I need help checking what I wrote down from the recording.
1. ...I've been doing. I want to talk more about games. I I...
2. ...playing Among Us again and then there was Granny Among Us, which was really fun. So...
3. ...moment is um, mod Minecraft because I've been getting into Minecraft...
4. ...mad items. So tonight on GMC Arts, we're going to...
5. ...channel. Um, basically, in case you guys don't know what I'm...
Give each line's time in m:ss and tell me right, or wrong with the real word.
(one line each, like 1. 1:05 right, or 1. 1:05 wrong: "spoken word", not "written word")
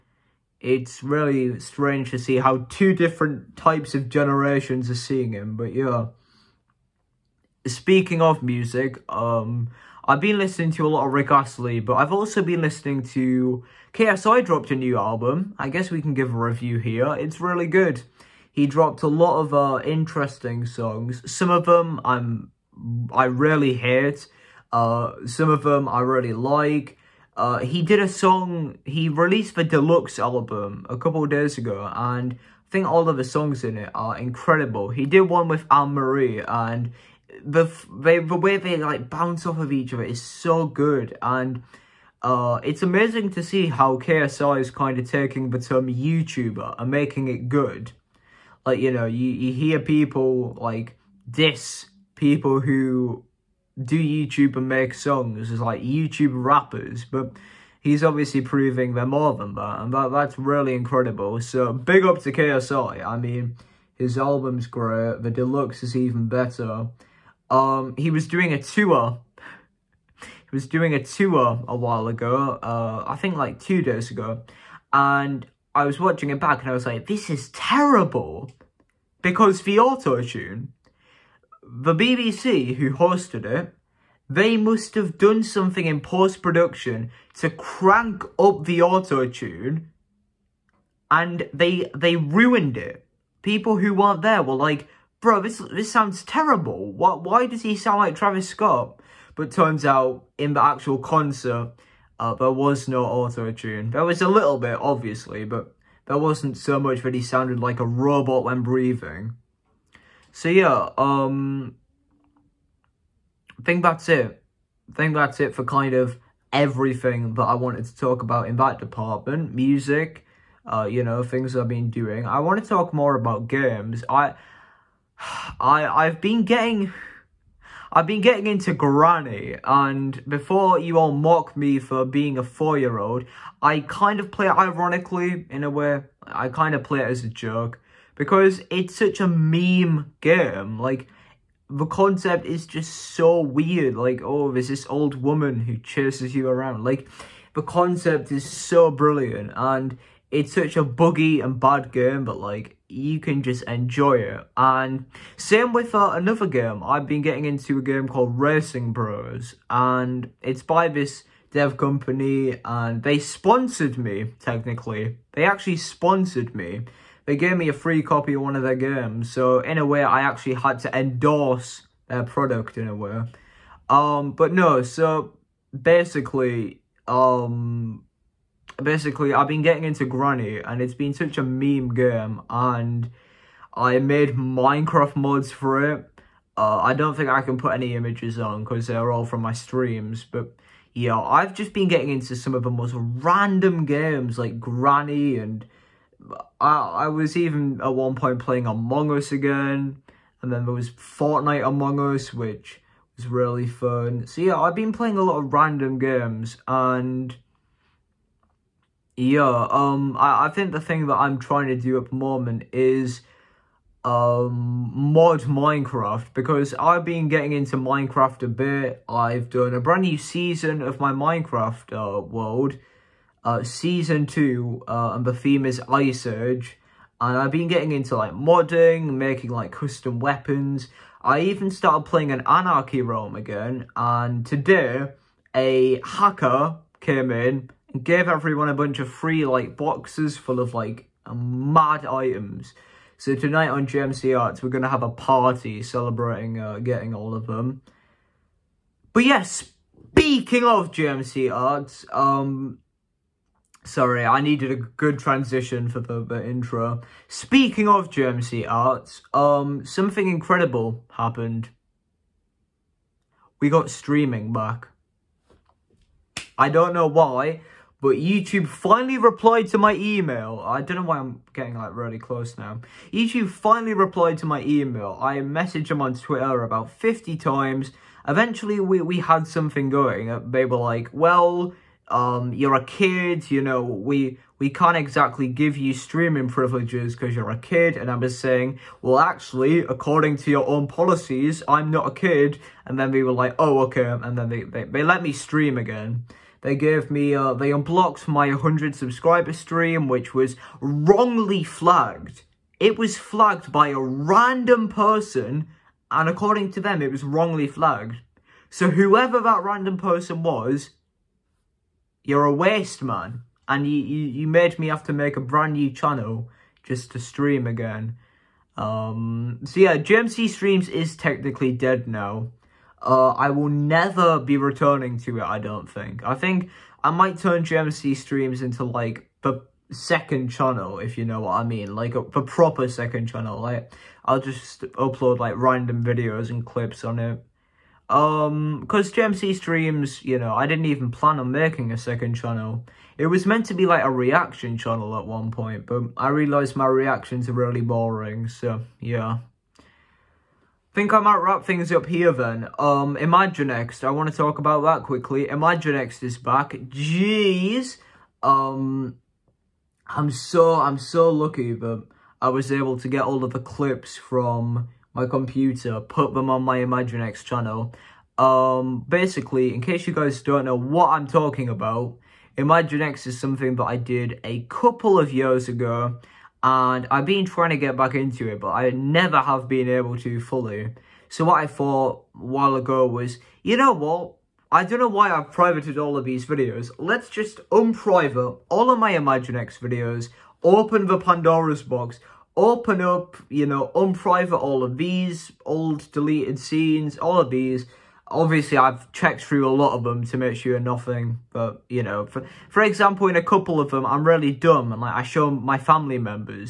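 1. 2:01 right
2. 3:18 wrong: "Fortnite", not "Granny"
3. 3:32 right
4. 4:01 right
5. 6:07 right.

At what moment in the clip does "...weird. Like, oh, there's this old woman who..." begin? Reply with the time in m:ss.
2:23.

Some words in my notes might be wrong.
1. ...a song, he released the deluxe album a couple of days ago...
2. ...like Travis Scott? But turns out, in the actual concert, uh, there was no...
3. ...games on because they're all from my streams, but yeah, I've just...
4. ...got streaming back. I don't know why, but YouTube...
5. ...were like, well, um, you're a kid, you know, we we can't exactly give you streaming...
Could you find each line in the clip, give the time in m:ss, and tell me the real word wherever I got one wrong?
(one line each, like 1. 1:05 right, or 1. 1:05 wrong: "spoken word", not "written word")
1. 0:27 right
2. 1:37 right
3. 3:07 wrong: "images", not "games"
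4. 4:23 right
5. 4:40 right.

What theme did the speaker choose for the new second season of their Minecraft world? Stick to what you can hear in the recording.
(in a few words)
Ice Age.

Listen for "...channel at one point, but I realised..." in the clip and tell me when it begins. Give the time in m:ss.
5:44.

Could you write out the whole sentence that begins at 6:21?
So what I thought a while ago was, you know what?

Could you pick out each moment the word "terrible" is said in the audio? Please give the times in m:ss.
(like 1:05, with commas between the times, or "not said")
1:17, 1:36.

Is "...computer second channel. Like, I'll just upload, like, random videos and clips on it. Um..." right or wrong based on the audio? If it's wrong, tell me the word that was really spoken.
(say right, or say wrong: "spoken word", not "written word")
wrong: "proper", not "computer".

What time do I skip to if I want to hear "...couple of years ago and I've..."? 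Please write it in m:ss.
6:14.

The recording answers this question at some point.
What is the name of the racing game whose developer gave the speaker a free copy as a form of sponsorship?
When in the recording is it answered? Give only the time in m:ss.
2:38.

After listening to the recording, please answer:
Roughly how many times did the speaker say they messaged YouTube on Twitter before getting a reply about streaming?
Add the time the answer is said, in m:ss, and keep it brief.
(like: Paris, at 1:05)
50, at 4:36.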